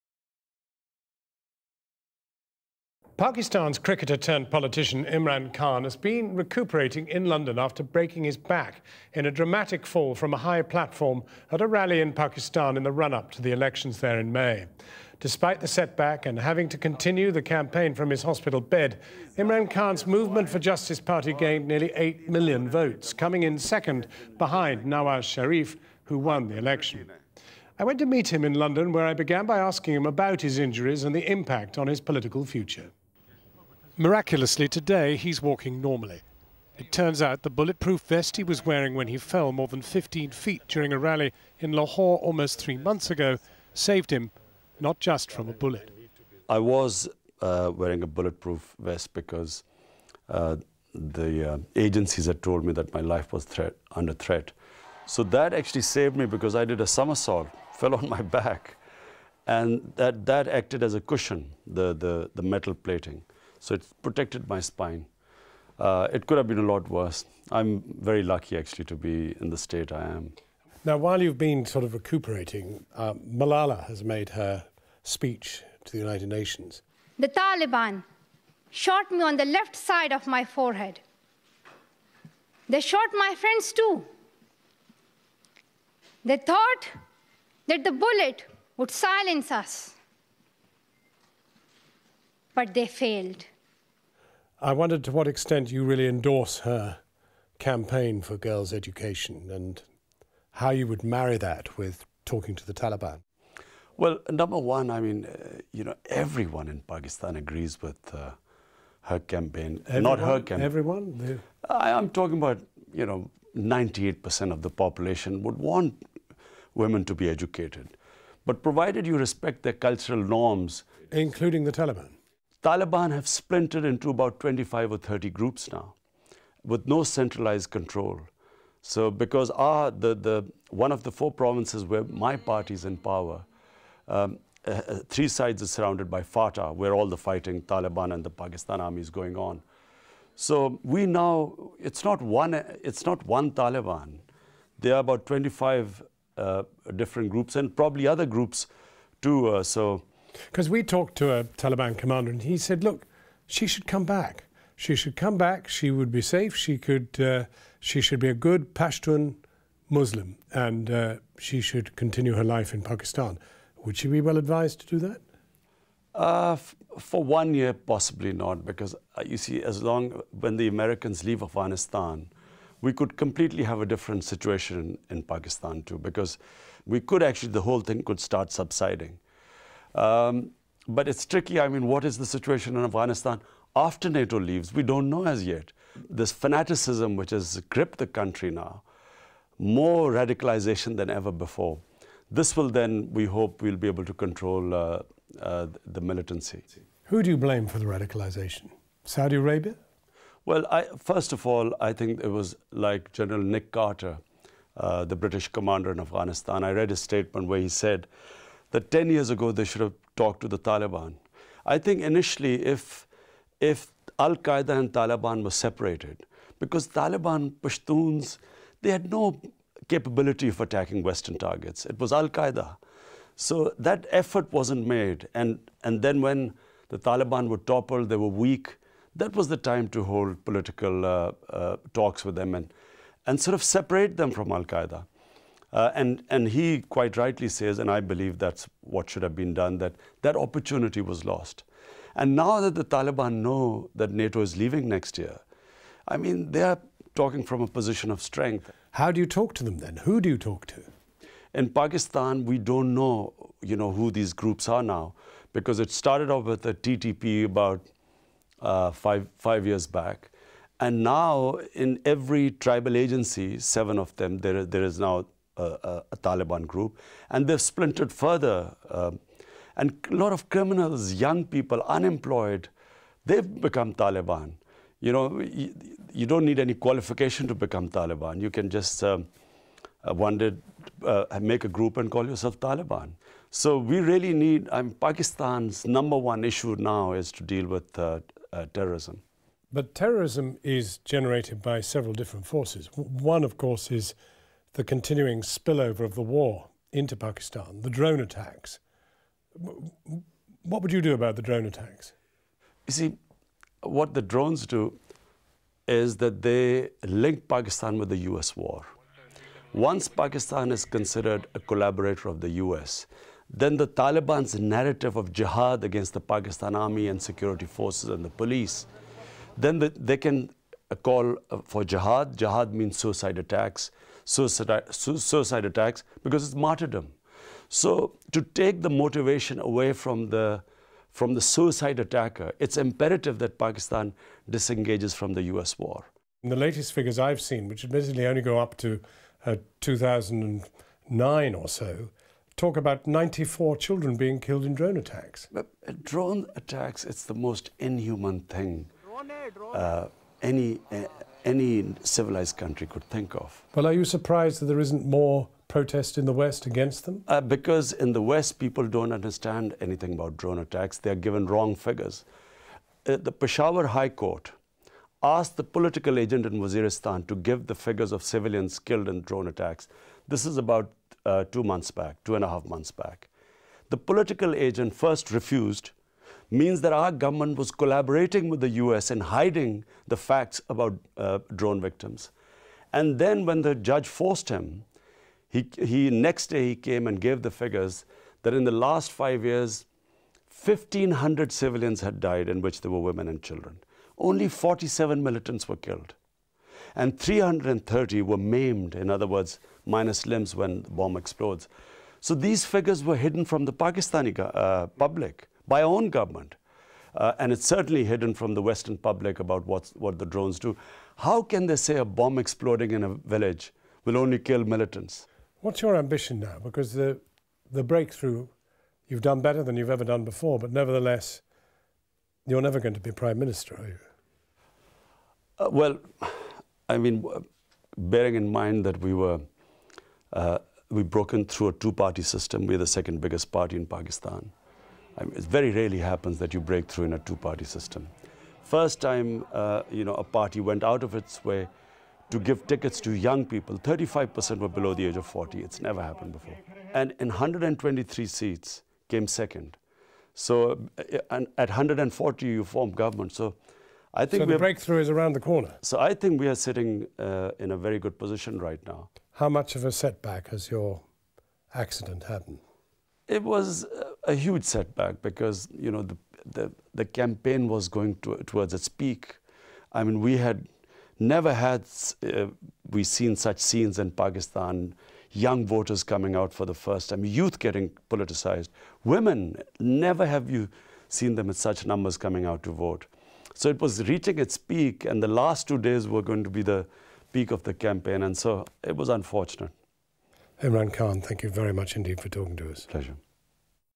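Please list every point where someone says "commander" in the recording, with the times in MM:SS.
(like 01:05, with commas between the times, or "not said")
02:31, 03:25.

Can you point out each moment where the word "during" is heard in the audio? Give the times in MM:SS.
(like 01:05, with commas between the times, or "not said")
00:40.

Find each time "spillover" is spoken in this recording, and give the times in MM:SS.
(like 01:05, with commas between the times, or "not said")
04:55.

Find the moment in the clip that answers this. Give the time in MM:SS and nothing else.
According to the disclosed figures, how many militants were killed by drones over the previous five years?
06:34.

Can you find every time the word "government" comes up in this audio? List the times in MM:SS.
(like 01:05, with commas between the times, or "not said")
06:17, 06:46, 07:32.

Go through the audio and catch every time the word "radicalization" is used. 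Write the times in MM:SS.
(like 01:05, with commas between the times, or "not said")
03:10, 03:17.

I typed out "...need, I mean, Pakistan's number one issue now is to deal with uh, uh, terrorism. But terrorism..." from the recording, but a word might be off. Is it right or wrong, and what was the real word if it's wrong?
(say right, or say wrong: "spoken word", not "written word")
right.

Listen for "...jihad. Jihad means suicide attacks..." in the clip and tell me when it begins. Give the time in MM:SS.
05:21.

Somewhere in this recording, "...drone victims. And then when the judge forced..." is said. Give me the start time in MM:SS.
06:21.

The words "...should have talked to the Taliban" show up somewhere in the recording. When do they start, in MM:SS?
03:29.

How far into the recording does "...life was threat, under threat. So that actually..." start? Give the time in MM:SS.
00:53.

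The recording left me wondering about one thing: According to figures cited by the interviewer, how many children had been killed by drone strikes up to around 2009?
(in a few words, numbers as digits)
94.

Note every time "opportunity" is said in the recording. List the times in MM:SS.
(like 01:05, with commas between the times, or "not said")
04:00.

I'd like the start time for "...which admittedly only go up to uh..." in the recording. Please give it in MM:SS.
05:37.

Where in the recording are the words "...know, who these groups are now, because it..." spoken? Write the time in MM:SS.
04:13.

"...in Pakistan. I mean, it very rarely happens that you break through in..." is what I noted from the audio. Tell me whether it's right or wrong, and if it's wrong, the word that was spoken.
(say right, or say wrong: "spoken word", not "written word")
right.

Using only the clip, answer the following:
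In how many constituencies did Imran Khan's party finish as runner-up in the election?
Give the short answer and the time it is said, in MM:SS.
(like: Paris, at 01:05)
123, at 07:27.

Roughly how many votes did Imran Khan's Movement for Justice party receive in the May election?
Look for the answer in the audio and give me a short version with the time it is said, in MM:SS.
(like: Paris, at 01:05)
8 million, at 00:21.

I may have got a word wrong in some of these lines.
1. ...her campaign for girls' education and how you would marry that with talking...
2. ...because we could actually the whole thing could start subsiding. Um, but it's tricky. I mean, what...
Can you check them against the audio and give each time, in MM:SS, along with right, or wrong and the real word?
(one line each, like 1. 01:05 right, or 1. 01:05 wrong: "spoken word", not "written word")
1. 01:36 right
2. 02:55 right.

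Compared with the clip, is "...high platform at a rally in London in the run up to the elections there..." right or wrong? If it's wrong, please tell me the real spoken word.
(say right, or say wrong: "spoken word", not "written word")
wrong: "Pakistan", not "London".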